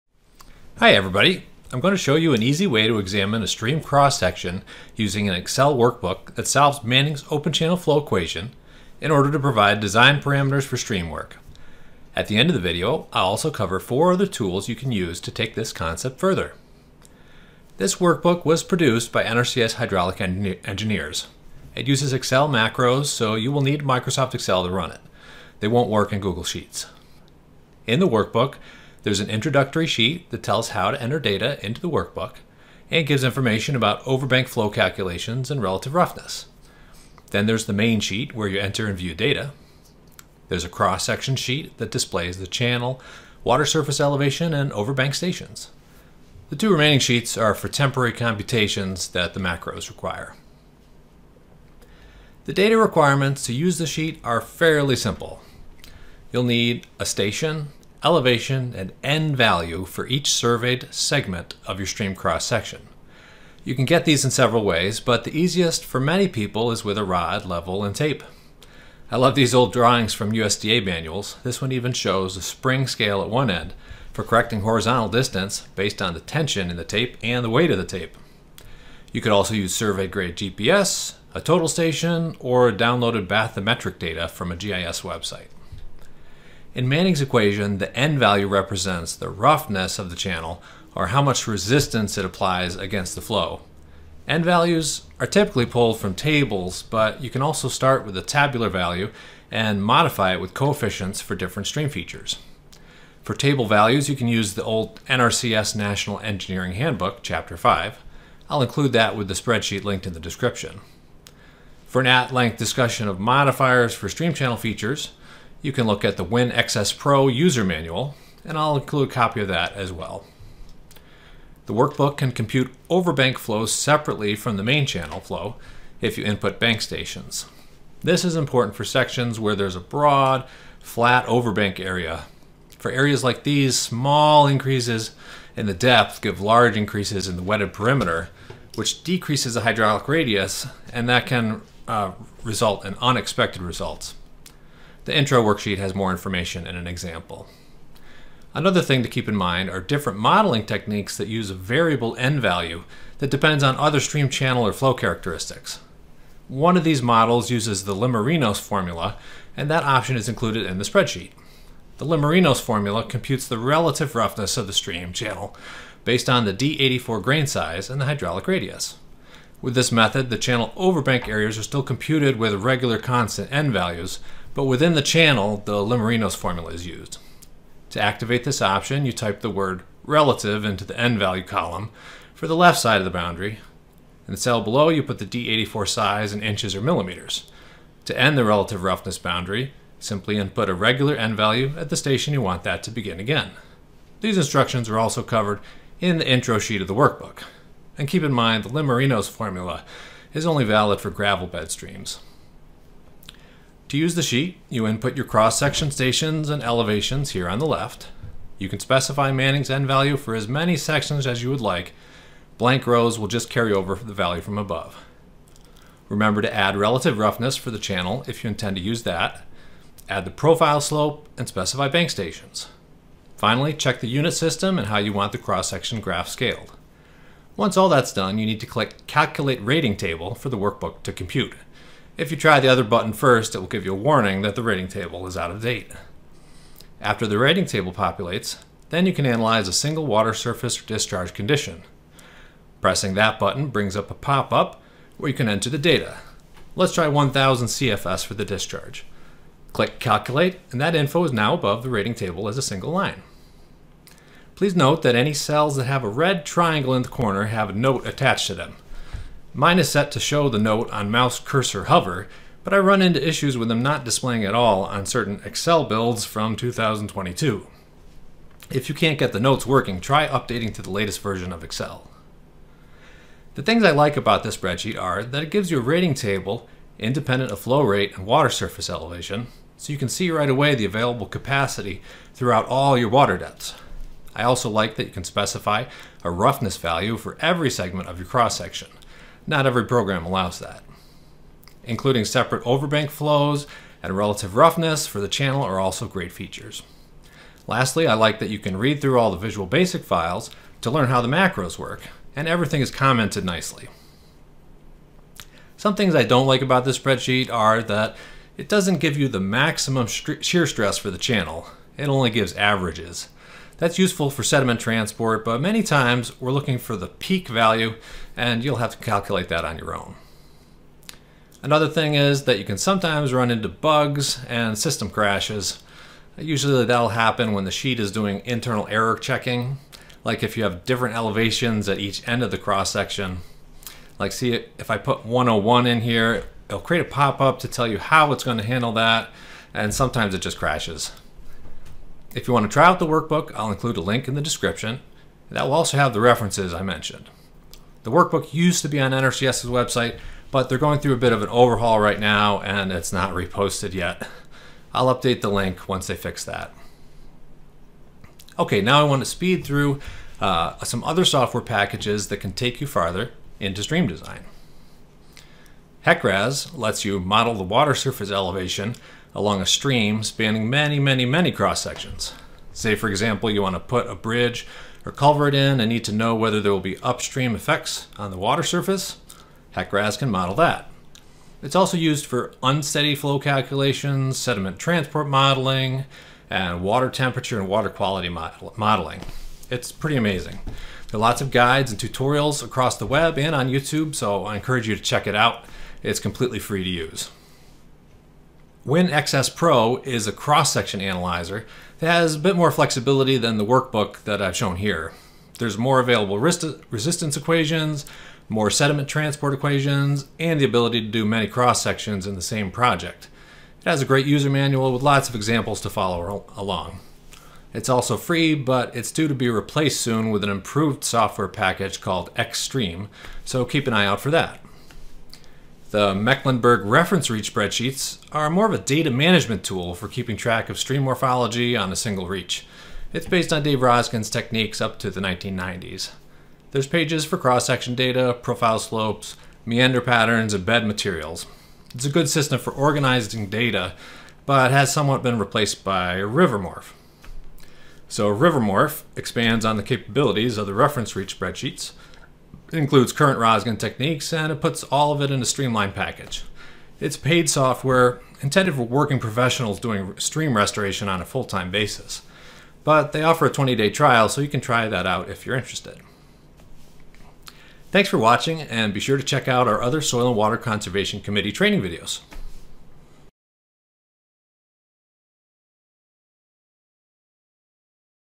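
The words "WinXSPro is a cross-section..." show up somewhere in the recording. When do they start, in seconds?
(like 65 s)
398 s.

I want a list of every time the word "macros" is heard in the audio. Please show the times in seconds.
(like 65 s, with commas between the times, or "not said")
22 s, 49 s, 301 s.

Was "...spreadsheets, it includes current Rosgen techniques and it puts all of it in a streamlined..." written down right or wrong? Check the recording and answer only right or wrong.
right.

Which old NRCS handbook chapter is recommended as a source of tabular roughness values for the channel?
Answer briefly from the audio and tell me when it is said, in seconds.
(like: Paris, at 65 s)
Chapter 5, at 107 s.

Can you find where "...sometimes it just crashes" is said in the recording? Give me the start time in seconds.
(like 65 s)
339 s.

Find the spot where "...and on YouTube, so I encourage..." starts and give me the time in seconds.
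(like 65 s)
393 s.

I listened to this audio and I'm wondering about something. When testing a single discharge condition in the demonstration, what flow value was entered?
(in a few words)
1000 CFS.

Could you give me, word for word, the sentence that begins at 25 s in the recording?
They won't work in Google Sheets.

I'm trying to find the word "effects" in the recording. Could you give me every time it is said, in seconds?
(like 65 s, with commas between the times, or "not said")
377 s.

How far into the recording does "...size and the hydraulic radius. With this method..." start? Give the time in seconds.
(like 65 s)
167 s.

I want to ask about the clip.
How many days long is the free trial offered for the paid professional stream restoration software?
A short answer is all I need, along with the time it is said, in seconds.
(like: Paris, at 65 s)
20 days, at 463 s.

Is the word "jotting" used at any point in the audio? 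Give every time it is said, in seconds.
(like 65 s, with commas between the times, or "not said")
not said.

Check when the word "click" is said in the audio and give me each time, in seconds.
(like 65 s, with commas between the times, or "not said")
228 s, 249 s.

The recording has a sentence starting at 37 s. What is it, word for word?
Then there's the main sheet where you enter and view data.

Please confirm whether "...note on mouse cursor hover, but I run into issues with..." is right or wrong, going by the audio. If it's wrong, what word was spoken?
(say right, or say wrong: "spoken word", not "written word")
right.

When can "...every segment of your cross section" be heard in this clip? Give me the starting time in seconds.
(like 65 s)
287 s.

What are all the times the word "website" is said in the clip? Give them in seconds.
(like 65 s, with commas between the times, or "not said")
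85 s, 349 s.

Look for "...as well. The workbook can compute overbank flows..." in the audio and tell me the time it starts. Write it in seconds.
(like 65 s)
119 s.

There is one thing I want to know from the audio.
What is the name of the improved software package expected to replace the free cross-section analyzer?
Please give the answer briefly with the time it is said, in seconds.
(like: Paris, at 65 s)
Xtreme, at 422 s.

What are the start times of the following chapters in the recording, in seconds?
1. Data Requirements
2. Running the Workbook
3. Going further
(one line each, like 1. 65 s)
1. 51 s
2. 203 s
3. 360 s.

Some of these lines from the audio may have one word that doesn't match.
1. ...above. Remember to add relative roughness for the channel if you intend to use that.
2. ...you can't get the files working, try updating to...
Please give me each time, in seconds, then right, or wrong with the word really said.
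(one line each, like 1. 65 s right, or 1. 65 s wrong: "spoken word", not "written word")
1. 214 s right
2. 268 s wrong: "notes", not "files".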